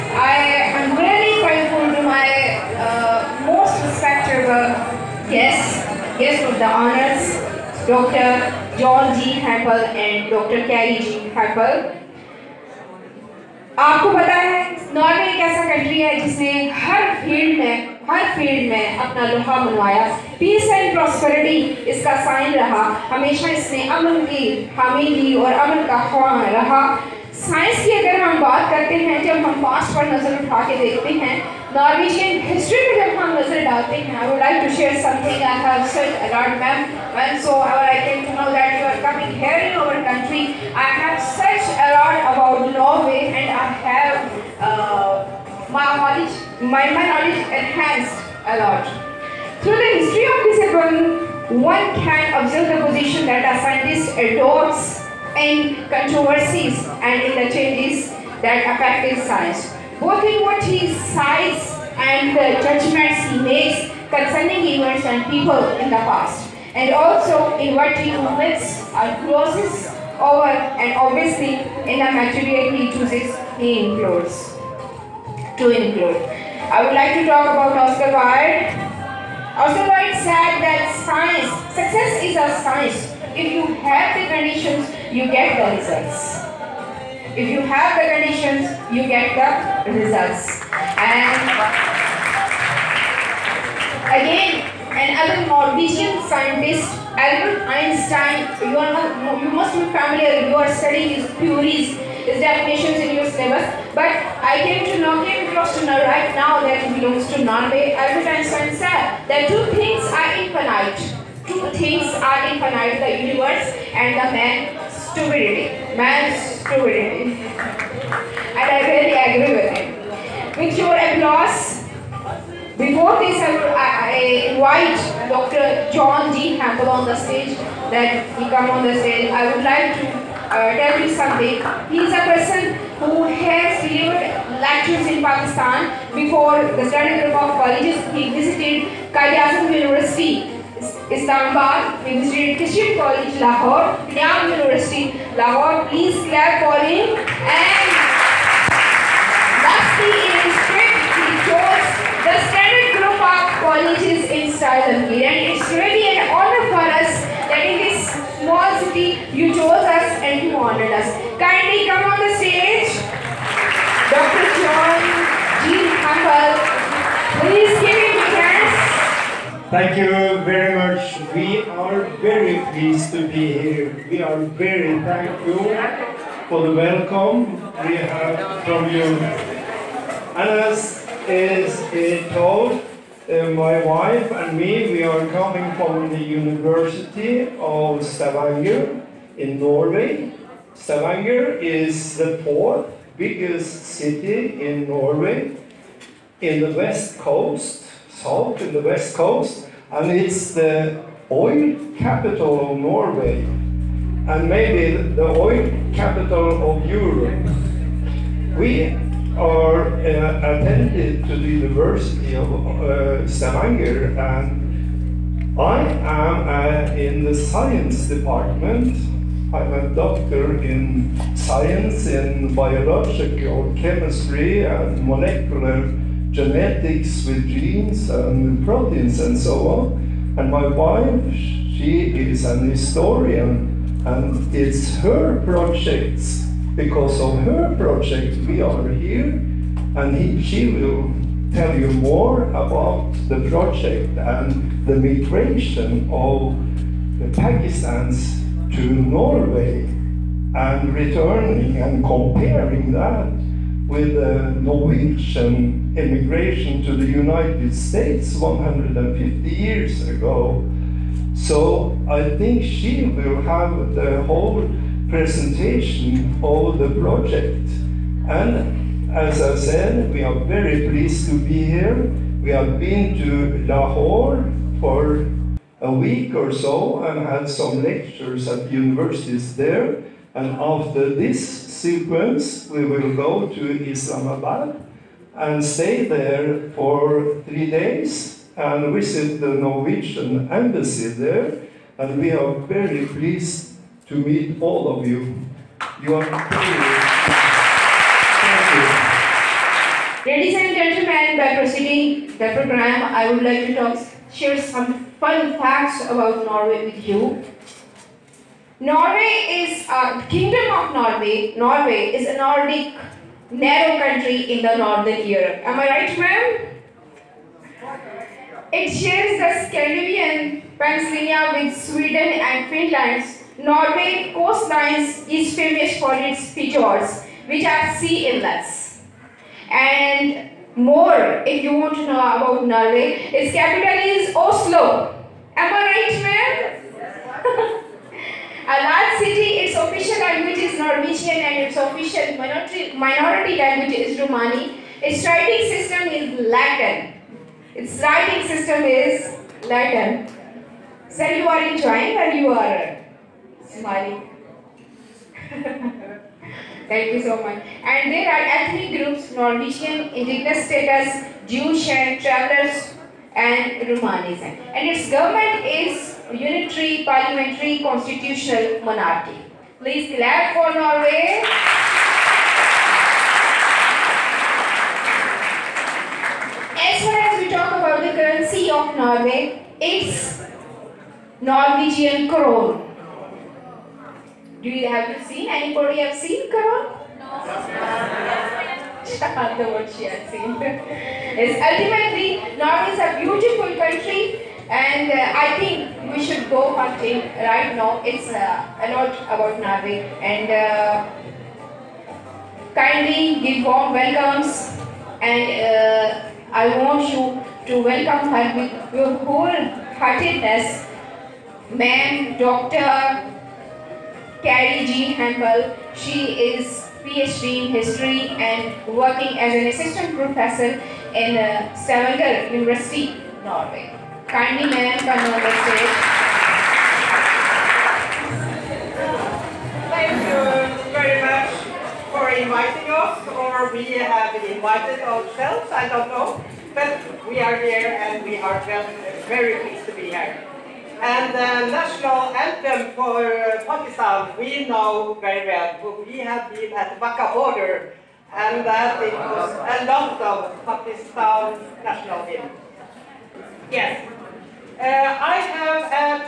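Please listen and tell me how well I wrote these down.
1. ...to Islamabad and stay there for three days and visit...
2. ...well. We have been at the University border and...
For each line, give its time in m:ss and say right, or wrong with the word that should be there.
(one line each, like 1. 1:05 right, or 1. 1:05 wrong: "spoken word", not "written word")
1. 4:43 right
2. 7:25 wrong: "Wagah", not "University".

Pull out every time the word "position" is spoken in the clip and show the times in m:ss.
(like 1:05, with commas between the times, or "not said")
0:52.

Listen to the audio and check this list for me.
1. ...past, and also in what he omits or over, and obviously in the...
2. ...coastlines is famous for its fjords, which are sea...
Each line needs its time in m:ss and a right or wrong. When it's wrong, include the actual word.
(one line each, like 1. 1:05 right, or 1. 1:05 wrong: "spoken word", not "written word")
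1. 1:06 right
2. 5:24 right.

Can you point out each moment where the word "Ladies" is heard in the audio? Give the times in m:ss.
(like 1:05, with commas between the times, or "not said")
5:00.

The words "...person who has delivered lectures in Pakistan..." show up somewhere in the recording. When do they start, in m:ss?
2:12.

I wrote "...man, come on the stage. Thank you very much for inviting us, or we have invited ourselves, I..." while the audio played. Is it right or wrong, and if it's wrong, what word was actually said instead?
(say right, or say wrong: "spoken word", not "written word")
right.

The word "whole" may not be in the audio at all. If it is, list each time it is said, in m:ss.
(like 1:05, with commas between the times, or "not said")
4:24, 6:49.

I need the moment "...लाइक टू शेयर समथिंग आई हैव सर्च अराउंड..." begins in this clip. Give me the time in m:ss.
0:34.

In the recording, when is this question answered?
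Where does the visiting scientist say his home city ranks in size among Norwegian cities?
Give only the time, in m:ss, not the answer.
3:12.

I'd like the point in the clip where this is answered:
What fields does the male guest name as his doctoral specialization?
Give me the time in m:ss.
3:42.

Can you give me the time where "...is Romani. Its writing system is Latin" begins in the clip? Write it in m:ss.
5:43.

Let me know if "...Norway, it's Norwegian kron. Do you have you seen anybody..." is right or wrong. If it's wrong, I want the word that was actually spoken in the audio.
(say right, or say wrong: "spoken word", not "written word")
right.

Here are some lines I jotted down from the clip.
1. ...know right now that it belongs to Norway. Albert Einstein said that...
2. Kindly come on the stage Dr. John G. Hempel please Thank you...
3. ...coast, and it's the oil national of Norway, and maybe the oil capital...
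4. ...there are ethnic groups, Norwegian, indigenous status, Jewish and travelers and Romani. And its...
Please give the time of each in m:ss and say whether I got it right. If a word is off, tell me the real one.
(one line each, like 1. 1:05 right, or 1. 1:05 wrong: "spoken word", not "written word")
1. 1:45 right
2. 2:41 right
3. 3:19 wrong: "capital", not "national"
4. 5:58 right.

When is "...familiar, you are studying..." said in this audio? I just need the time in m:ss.
1:39.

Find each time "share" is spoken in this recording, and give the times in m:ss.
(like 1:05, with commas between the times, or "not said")
5:04, 5:18.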